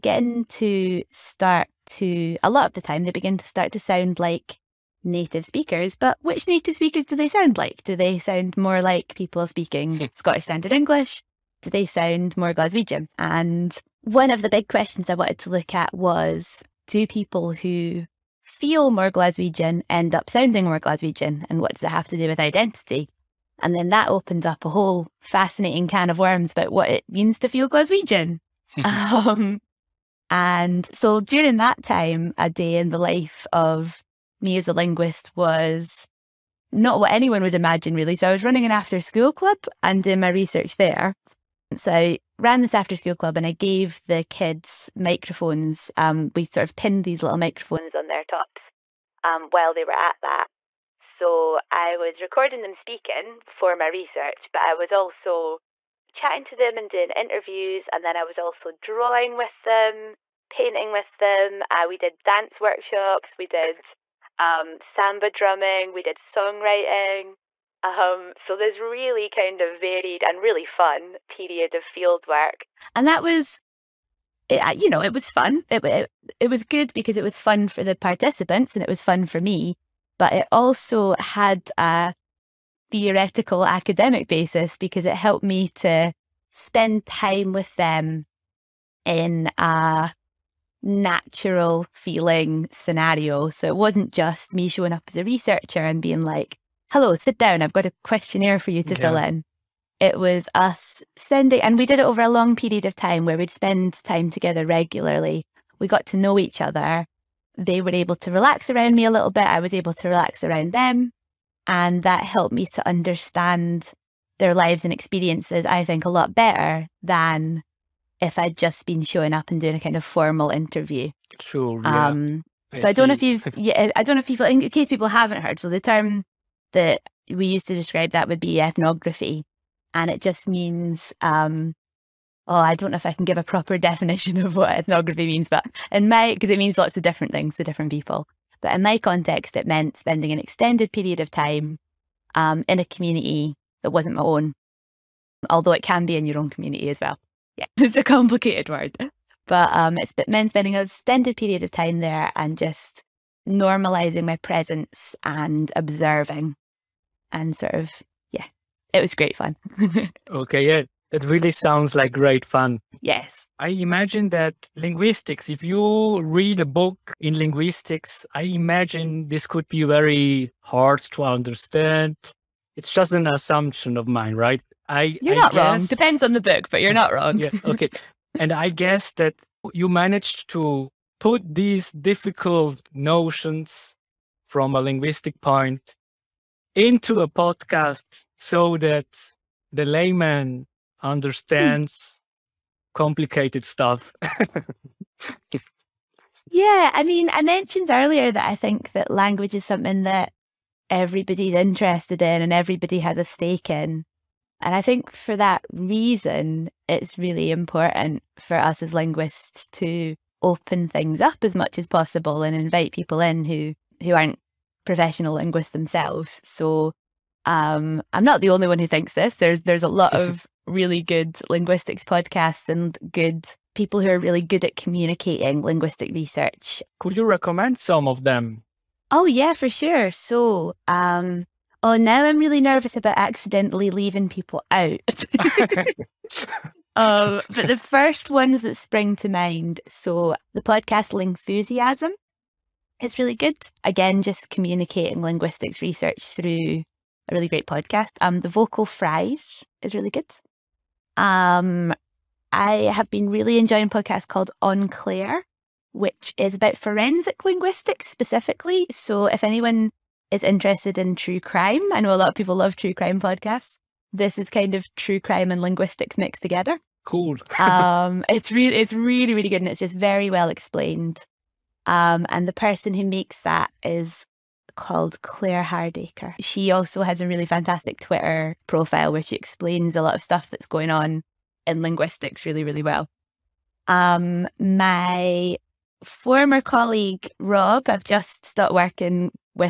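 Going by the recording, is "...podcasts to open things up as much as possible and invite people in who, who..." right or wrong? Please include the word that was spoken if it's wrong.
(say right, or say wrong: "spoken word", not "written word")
wrong: "linguists", not "podcasts".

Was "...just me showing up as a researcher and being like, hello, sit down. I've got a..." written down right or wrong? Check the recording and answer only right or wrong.
right.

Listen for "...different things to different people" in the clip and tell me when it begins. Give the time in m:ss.
2:17.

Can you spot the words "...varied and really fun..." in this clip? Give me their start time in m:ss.
1:09.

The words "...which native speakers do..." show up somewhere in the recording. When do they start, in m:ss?
0:06.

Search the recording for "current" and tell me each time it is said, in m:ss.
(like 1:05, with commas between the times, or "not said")
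not said.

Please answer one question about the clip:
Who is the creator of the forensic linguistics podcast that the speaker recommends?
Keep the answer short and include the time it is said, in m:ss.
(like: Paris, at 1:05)
Claire Hardaker, at 4:35.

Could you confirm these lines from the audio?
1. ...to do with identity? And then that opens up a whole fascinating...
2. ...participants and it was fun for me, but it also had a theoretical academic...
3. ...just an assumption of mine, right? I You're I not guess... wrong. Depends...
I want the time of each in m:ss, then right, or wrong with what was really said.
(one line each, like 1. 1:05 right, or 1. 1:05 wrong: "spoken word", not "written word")
1. 0:22 right
2. 1:17 right
3. 2:52 right.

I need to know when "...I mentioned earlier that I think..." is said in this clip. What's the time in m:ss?
3:17.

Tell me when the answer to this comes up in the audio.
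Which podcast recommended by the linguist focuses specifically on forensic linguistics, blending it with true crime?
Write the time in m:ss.
4:14.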